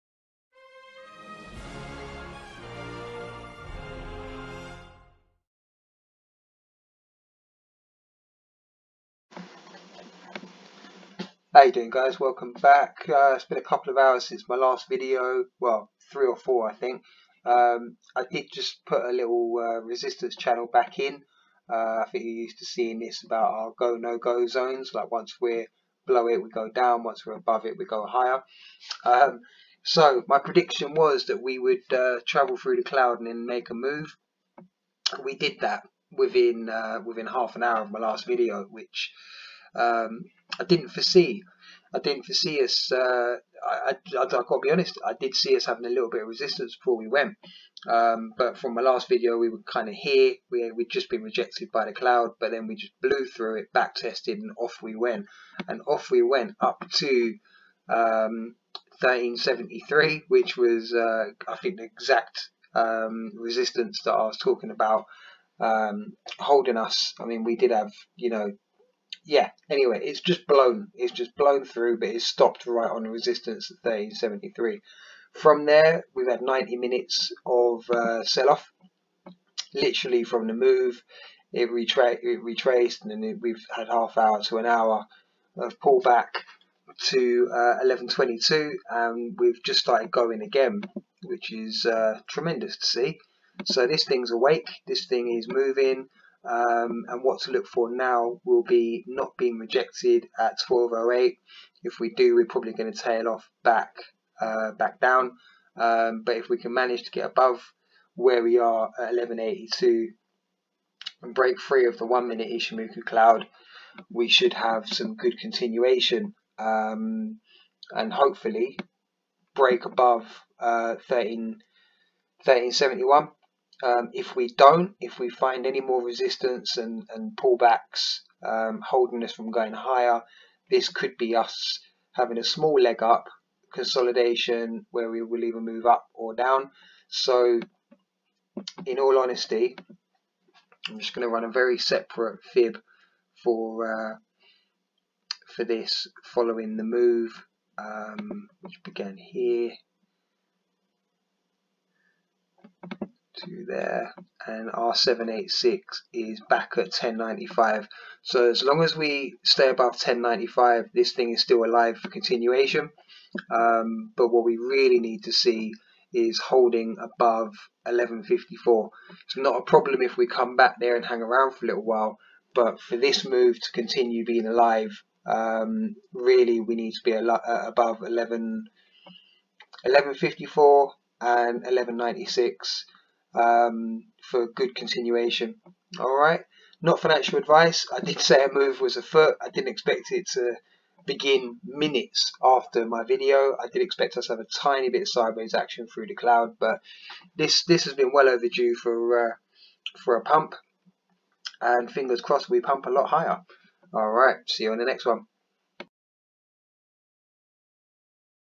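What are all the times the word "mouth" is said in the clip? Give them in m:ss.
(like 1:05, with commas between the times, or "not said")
not said.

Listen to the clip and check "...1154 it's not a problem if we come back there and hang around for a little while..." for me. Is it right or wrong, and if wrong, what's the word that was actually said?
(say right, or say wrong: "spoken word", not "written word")
right.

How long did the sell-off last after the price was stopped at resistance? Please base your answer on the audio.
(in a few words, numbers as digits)
90 minutes.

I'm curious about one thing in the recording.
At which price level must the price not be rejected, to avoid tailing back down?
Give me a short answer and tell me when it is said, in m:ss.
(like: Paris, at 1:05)
1208, at 1:40.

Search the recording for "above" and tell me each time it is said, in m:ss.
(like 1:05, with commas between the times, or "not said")
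0:27, 1:47, 1:59, 2:39, 2:46, 2:57.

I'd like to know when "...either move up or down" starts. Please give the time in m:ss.
2:15.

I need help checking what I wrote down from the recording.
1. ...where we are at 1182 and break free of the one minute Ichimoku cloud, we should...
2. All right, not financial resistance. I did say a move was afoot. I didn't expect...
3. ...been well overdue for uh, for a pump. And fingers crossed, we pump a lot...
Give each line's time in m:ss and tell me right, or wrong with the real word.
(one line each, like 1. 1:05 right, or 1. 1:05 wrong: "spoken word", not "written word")
1. 1:48 right
2. 3:05 wrong: "advice", not "resistance"
3. 3:17 right.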